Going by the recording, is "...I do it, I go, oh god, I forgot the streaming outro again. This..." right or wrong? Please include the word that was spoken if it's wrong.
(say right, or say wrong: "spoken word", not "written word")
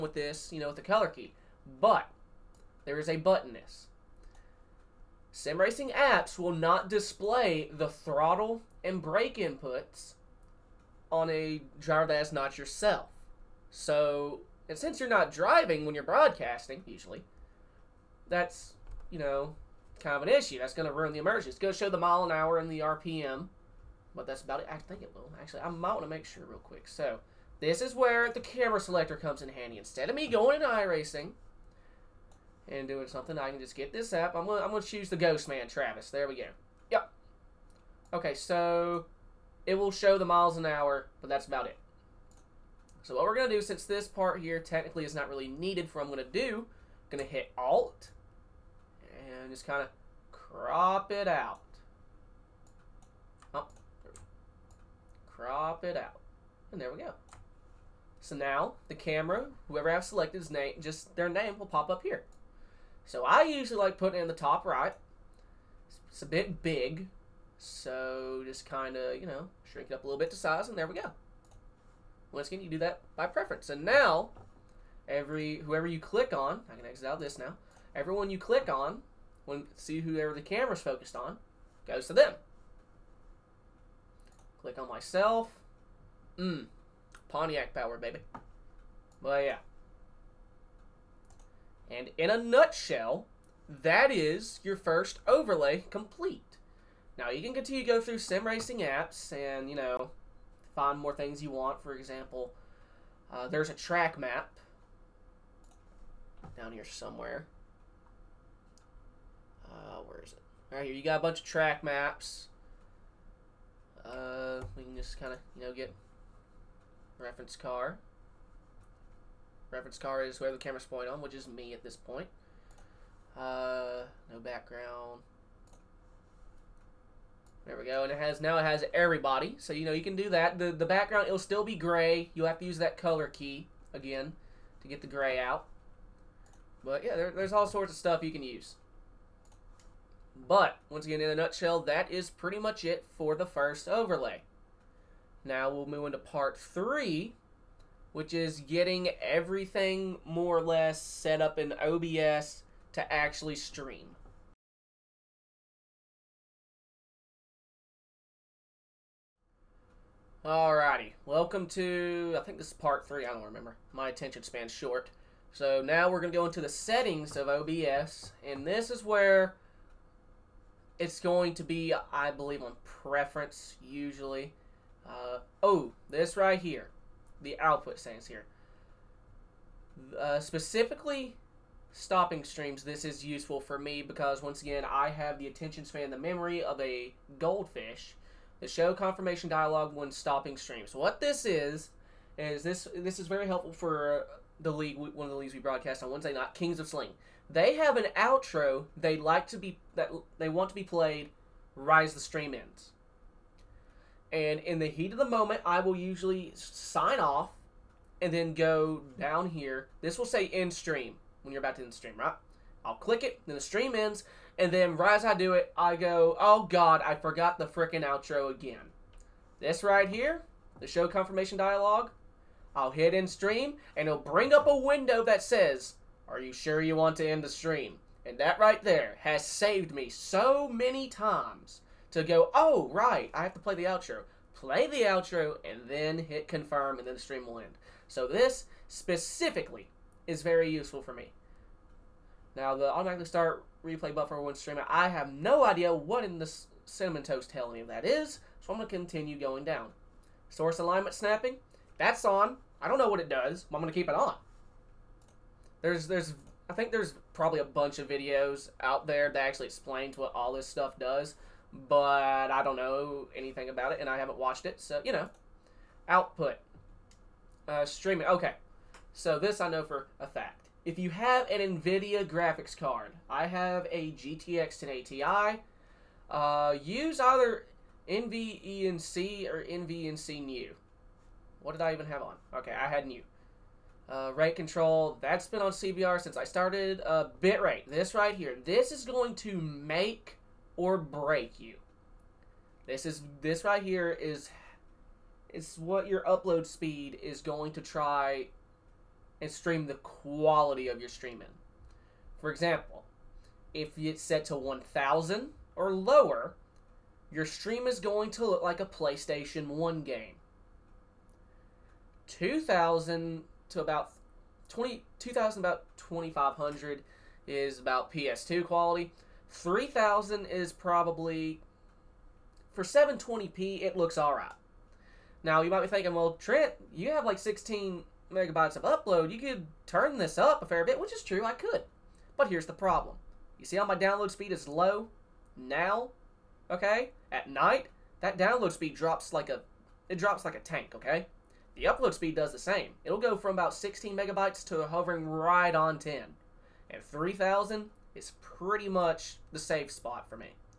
wrong: "freaking", not "streaming".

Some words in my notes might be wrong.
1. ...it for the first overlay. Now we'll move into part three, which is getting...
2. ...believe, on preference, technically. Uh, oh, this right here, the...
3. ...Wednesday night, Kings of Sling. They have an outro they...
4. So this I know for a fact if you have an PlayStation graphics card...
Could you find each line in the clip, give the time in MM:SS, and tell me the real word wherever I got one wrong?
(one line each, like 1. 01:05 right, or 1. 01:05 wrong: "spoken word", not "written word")
1. 02:22 right
2. 02:52 wrong: "usually", not "technically"
3. 03:16 right
4. 04:29 wrong: "NVIDIA", not "PlayStation".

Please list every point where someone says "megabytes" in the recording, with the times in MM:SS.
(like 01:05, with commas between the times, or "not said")
05:28, 05:44.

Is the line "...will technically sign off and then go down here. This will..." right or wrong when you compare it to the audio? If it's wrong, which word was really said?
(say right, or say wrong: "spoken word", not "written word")
wrong: "usually", not "technically".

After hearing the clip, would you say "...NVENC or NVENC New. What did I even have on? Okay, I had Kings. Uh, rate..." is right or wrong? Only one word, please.
wrong.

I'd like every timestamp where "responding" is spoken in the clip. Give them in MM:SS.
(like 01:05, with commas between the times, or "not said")
not said.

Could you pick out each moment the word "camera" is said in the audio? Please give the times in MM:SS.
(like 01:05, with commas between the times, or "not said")
00:28, 00:58, 01:20, 02:00.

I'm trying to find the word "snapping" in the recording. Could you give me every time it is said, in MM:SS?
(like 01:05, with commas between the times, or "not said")
04:11.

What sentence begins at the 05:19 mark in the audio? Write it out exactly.
3000 is probably for 720p it looks all right.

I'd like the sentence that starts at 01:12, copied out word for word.
Once again, you do that by preference.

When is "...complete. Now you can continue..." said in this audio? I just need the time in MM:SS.
01:35.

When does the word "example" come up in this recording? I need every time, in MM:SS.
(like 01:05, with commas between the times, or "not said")
01:41, 05:02.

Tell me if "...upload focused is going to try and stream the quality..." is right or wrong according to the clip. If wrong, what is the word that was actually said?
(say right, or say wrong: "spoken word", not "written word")
wrong: "speed", not "focused".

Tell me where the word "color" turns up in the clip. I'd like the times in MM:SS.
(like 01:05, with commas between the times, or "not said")
00:00, 02:12.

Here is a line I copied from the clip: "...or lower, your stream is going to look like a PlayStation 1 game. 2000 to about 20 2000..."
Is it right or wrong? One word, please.
right.